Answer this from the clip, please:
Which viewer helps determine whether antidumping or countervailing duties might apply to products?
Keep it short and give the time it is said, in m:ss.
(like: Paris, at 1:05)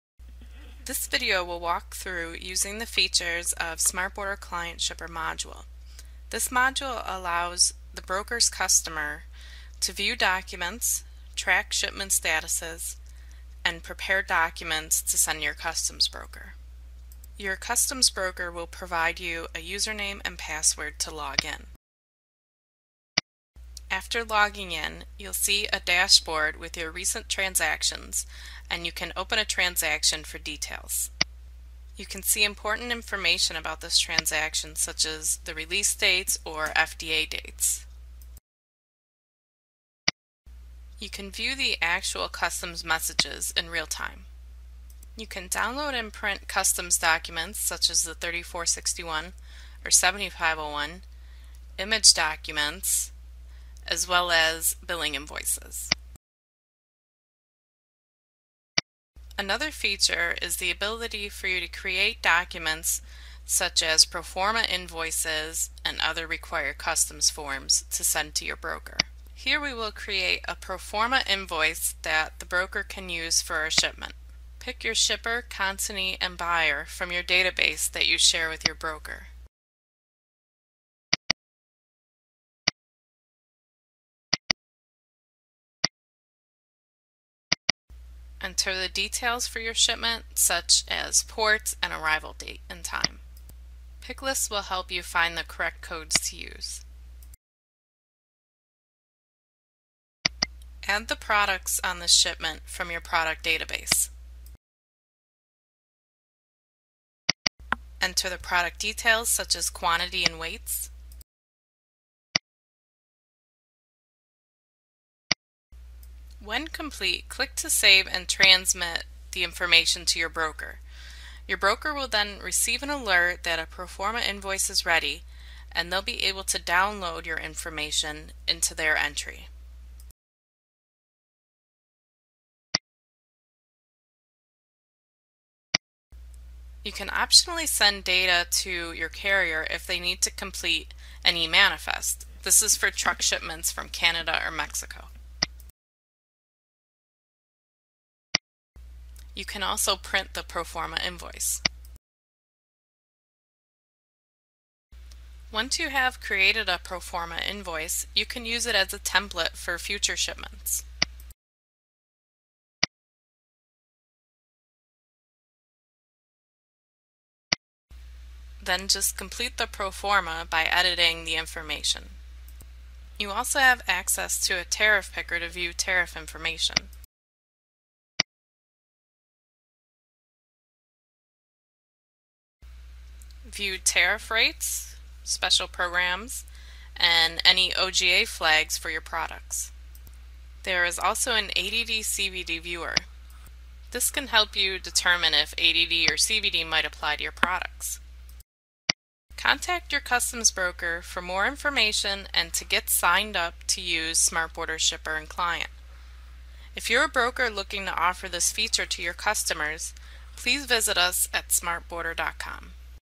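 ADD CVD viewer, at 3:11.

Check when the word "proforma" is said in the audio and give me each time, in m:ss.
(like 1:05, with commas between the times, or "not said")
1:04, 1:10, 2:03, 2:30, 2:36, 2:49.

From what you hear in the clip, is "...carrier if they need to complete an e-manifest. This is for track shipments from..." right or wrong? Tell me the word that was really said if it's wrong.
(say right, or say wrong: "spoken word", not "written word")
wrong: "truck", not "track".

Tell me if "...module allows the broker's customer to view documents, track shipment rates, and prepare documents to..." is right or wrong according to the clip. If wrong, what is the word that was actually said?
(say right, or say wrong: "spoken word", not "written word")
wrong: "statuses", not "rates".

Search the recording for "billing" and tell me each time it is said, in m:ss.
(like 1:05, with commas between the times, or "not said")
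0:54.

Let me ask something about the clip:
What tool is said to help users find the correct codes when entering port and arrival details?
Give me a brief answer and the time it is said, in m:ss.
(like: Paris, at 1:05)
Picklist, at 1:34.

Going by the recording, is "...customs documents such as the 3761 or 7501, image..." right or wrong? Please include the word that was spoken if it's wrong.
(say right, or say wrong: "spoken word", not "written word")
wrong: "3461", not "3761".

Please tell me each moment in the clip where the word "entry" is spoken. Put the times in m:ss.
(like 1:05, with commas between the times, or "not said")
2:08.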